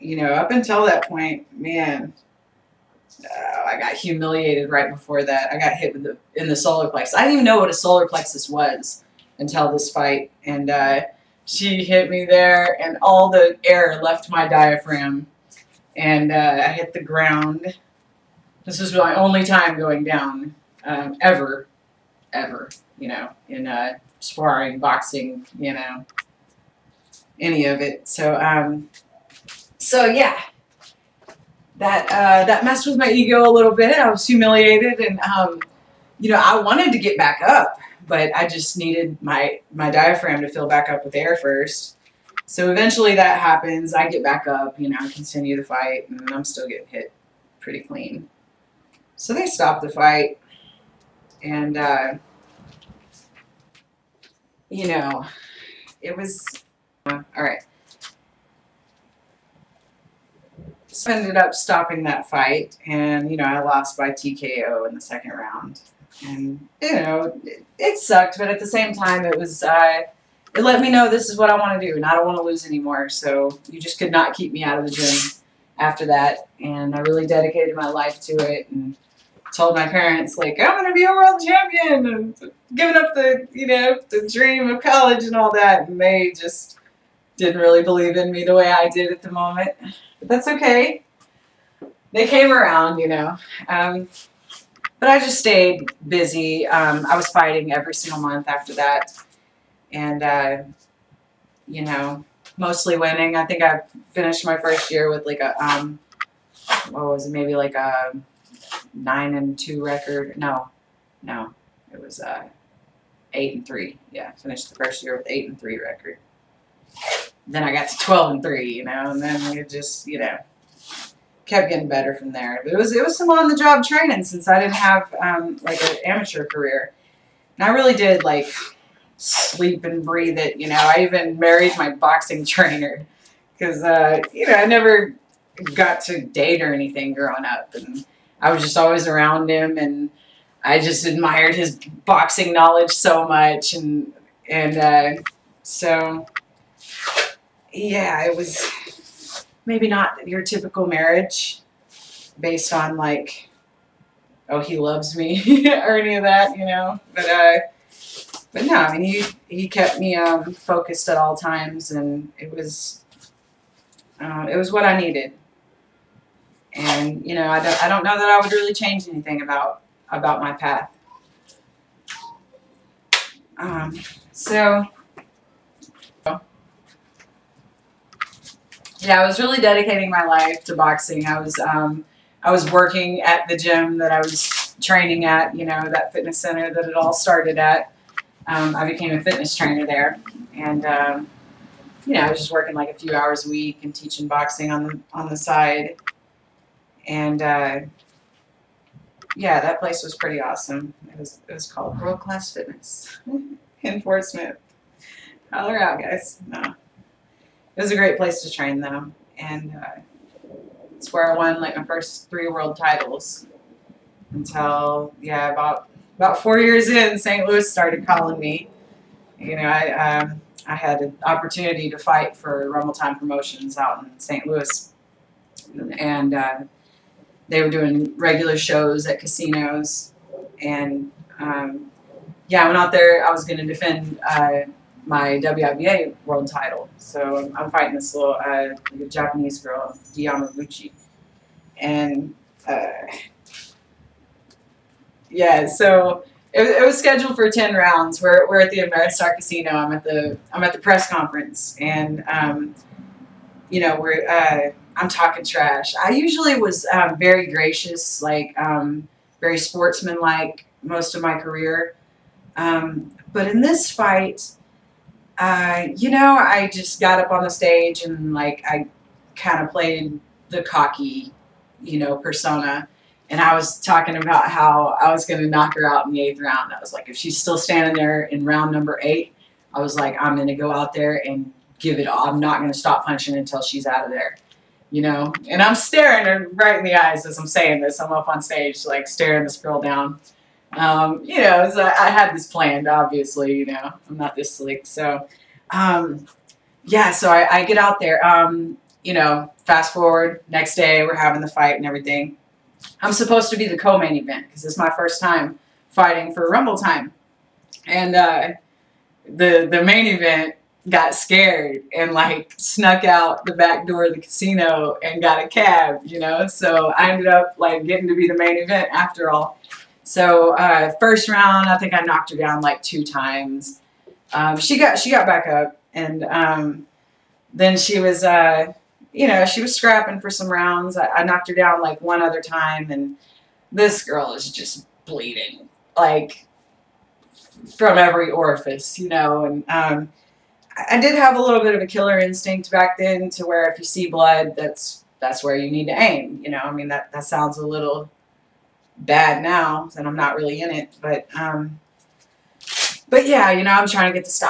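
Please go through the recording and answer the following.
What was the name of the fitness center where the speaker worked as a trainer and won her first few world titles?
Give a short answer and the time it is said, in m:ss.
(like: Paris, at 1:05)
World Class Fitness, at 3:22.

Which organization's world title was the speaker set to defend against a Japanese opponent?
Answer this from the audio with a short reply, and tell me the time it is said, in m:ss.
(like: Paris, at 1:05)
WIBA, at 3:55.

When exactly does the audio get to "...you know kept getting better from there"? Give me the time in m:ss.
2:00.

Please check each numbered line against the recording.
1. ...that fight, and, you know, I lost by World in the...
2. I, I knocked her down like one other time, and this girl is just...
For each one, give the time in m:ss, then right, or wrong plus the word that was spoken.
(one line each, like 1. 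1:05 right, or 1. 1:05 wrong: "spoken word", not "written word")
1. 1:02 wrong: "TKO", not "World"
2. 5:30 right.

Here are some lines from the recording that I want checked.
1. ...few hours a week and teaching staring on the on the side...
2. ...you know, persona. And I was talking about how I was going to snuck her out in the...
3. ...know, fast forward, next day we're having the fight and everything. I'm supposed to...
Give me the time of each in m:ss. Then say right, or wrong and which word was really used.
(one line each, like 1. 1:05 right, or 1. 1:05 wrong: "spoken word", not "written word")
1. 3:12 wrong: "boxing", not "staring"
2. 4:31 wrong: "knock", not "snuck"
3. 4:59 right.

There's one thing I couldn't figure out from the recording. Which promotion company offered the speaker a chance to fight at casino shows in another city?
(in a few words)
Rumble Time Promotions.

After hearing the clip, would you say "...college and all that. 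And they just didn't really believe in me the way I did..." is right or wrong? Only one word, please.
right.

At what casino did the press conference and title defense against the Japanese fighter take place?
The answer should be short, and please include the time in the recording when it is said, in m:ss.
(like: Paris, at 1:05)
Ameristar Casino, at 4:08.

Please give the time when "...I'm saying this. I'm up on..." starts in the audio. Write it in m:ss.
4:47.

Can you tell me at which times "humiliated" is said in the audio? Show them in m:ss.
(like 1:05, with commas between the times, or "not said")
0:03, 0:34.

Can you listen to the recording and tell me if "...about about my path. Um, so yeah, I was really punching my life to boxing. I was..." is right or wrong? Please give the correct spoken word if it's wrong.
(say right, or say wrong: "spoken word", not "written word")
wrong: "dedicating", not "punching".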